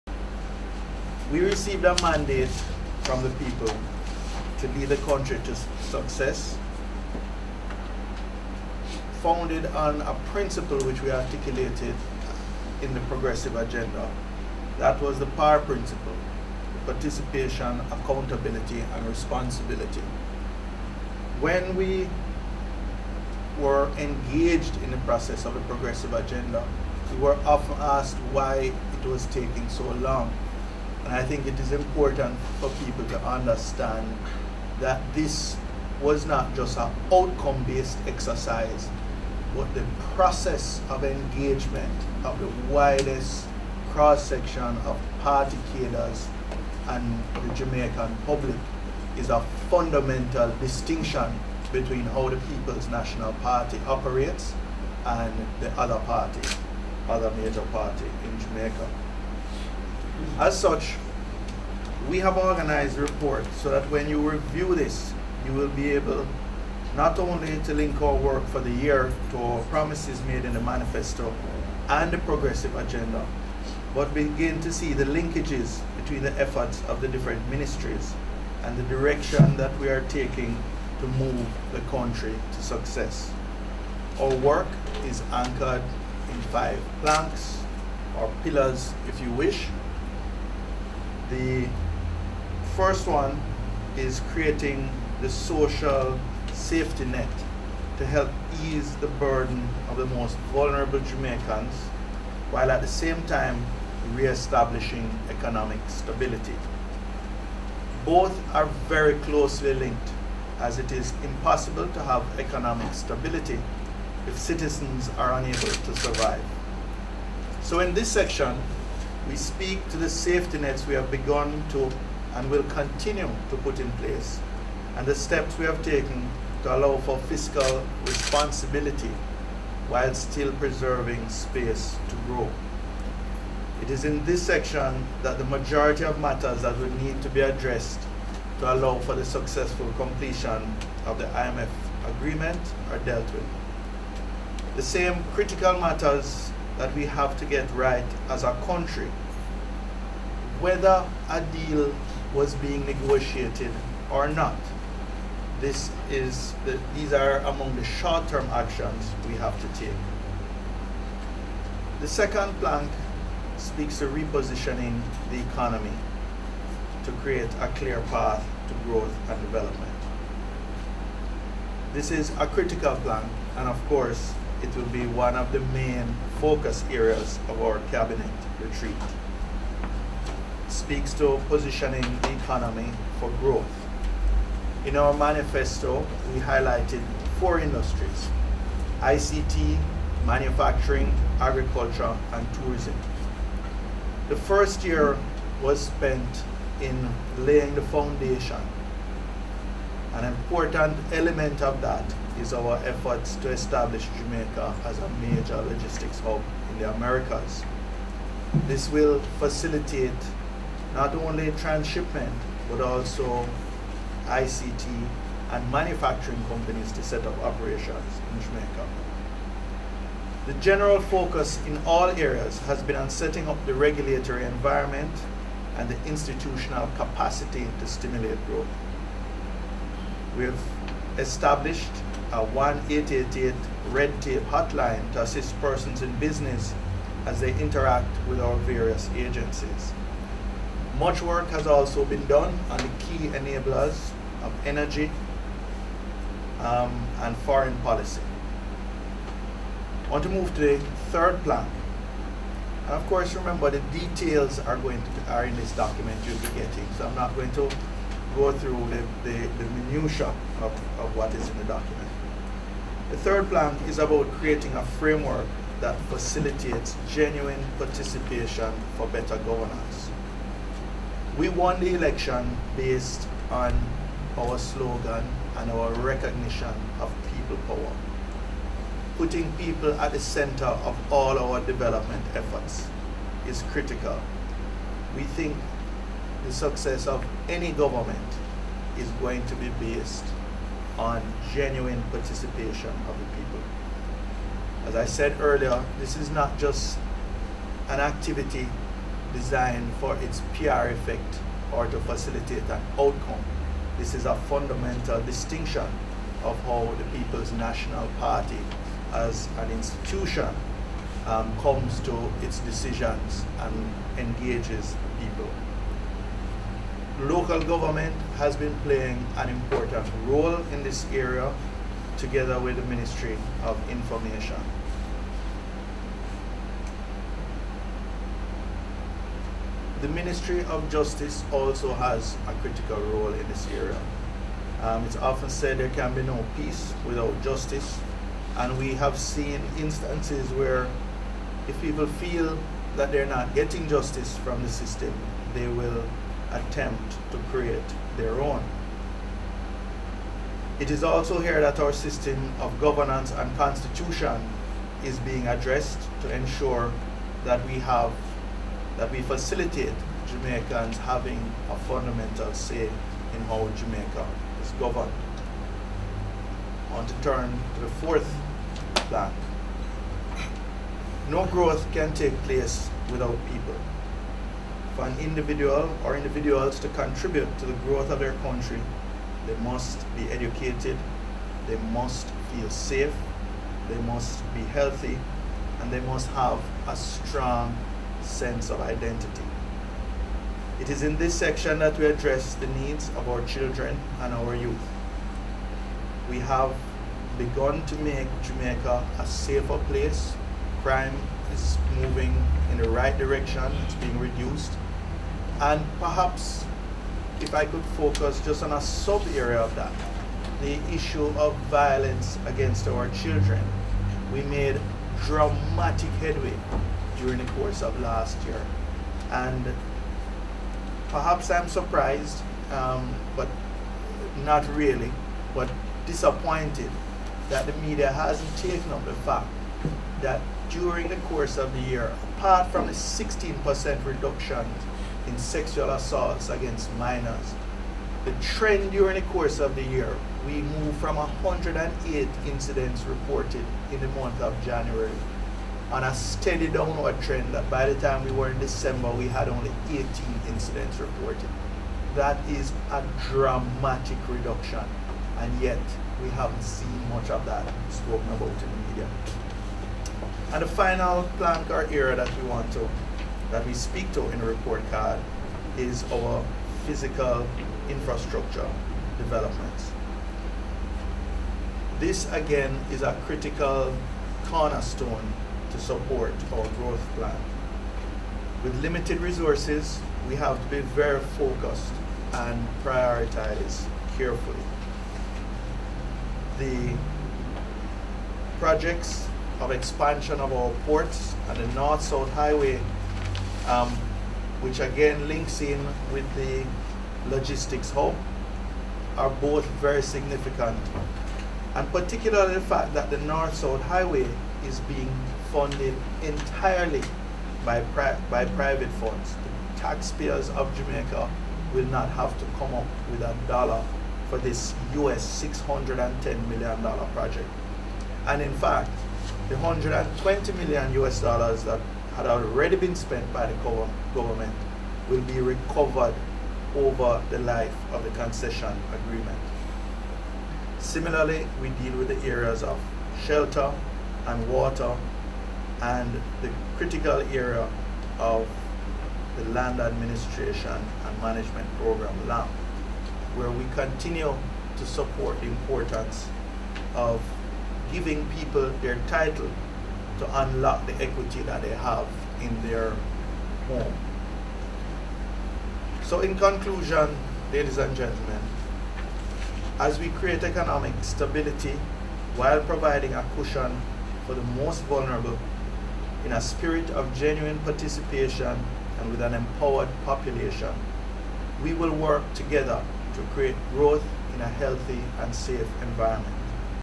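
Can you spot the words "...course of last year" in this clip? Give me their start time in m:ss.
6:57.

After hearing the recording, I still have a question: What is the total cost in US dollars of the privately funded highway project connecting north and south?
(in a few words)
US$610 million.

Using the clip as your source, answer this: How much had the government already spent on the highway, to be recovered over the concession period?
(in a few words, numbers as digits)
US$120 million.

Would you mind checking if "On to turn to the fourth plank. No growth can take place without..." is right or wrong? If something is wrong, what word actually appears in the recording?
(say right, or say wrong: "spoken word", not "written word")
right.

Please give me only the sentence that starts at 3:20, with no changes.
An important element of that is our efforts to establish Jamaica as a major logistics hub in the Americas.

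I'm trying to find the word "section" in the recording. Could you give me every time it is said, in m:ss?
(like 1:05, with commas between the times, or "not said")
0:43, 1:58, 2:14, 6:31.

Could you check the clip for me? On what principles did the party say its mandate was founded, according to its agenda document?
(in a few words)
participation, accountability, and responsibility.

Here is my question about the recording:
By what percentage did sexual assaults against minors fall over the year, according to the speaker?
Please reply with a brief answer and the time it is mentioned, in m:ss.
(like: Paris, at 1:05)
16%, at 7:12.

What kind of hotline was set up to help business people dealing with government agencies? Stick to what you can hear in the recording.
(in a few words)
red tape hotline.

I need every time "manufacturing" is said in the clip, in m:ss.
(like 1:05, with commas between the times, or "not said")
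3:10, 3:35.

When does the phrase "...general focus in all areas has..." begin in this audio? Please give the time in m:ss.
3:40.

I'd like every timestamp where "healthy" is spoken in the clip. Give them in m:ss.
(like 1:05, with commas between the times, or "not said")
6:24, 9:34.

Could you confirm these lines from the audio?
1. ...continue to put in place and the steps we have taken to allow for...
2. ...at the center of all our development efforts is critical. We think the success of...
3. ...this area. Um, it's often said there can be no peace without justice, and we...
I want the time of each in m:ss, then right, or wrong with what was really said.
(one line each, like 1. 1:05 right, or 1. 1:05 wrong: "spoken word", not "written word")
1. 2:02 right
2. 4:39 right
3. 5:33 right.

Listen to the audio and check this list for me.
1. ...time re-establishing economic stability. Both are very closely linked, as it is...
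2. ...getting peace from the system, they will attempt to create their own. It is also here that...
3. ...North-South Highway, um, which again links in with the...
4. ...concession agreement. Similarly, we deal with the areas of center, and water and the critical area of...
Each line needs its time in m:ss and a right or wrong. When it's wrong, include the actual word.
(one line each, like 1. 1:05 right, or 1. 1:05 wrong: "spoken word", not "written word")
1. 1:43 right
2. 5:43 wrong: "justice", not "peace"
3. 8:11 right
4. 8:48 wrong: "shelter", not "center".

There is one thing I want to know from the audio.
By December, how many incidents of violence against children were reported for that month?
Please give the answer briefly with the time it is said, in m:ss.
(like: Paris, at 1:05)
18, at 7:29.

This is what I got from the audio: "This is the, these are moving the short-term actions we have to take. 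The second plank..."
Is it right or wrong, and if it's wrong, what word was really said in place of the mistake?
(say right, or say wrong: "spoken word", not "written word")
wrong: "among", not "moving".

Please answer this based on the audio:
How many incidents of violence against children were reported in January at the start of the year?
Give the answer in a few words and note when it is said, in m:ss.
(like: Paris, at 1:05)
108, at 7:21.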